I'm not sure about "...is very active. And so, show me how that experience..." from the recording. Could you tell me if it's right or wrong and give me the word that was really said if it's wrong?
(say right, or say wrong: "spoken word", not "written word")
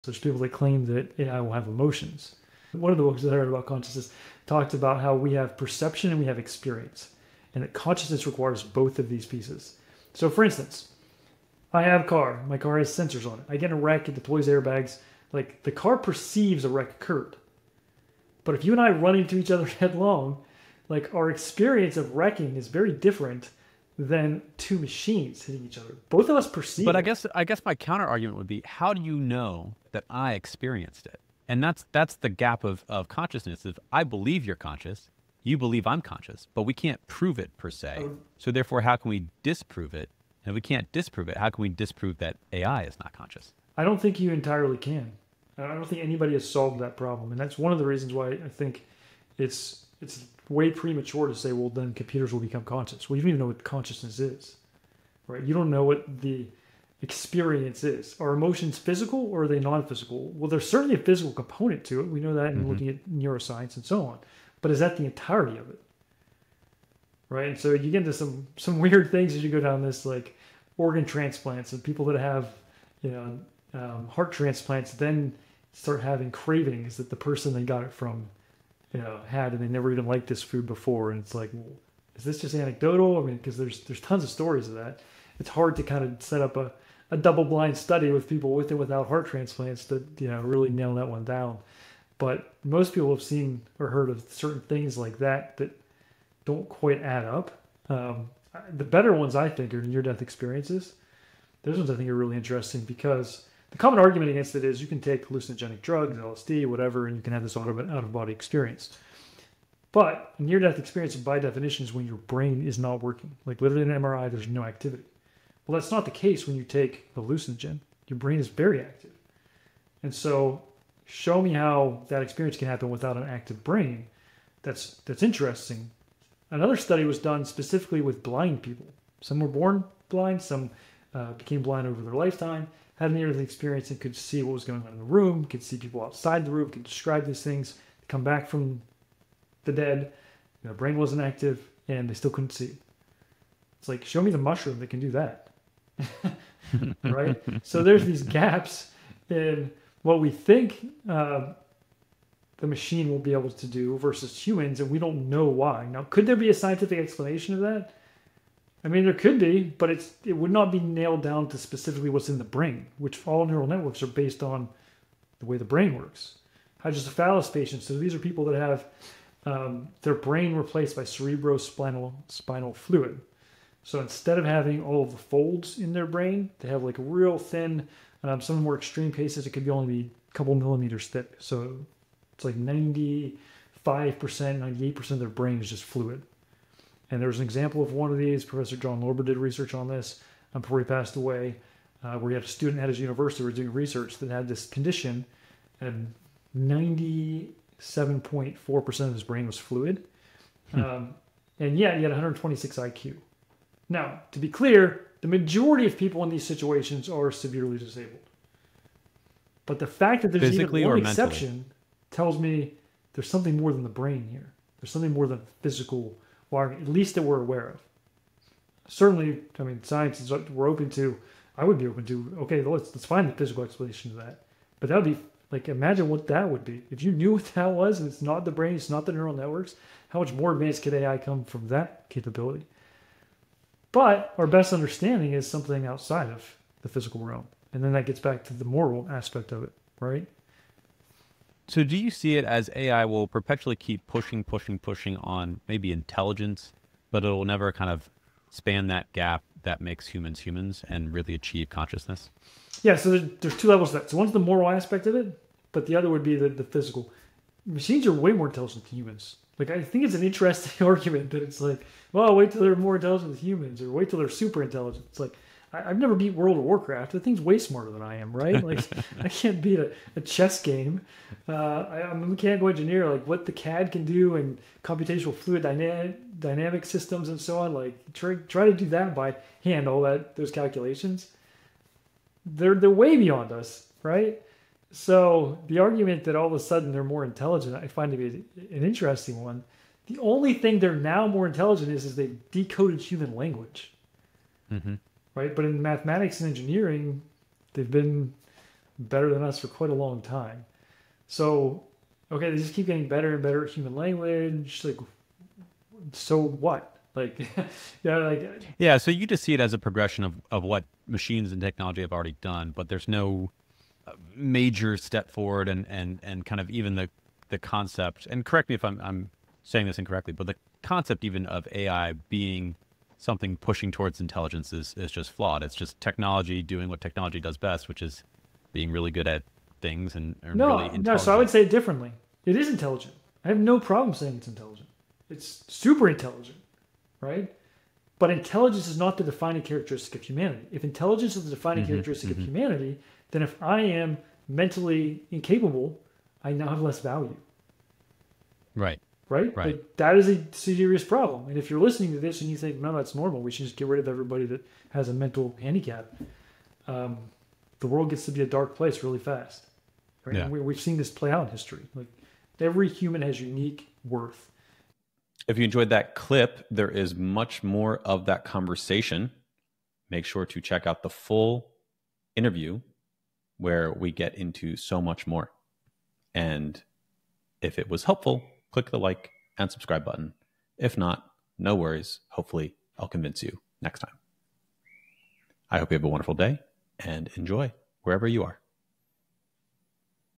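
right.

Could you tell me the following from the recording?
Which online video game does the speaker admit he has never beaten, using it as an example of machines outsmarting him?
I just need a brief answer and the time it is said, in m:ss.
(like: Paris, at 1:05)
World of Warcraft, at 4:26.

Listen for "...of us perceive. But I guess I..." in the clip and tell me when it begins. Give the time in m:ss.
0:26.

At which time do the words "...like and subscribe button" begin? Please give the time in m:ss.
6:18.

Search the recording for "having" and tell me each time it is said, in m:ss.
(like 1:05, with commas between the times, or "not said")
1:16, 2:54.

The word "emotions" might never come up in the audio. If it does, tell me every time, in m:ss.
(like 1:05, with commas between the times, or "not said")
0:01, 0:58.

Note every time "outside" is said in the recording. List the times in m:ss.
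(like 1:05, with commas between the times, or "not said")
2:16, 3:55.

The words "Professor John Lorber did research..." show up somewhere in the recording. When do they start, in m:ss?
3:08.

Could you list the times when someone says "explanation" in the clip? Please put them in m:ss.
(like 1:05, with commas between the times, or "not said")
2:36, 3:43.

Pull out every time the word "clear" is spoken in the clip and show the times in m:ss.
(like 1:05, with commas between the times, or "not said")
3:24.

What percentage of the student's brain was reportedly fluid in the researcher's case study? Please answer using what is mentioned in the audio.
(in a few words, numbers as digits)
97.4%.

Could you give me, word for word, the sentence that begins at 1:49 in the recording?
But near death experience, by definition, is when your brain is not working.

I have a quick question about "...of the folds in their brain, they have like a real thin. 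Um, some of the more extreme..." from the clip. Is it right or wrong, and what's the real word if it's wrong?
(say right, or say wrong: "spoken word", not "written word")
right.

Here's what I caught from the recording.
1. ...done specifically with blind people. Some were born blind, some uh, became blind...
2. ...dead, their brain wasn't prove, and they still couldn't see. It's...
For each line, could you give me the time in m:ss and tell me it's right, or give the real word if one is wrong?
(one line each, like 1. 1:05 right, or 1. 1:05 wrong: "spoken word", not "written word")
1. 2:07 right
2. 2:19 wrong: "active", not "prove".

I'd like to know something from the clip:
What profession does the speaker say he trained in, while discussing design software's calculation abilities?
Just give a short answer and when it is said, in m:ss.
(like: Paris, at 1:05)
mechanical engineer, at 4:32.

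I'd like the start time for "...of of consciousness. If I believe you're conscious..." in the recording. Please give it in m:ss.
0:32.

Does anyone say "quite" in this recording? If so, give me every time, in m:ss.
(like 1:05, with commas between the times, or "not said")
1:36, 4:59.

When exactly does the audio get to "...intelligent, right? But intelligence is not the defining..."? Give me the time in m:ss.
5:36.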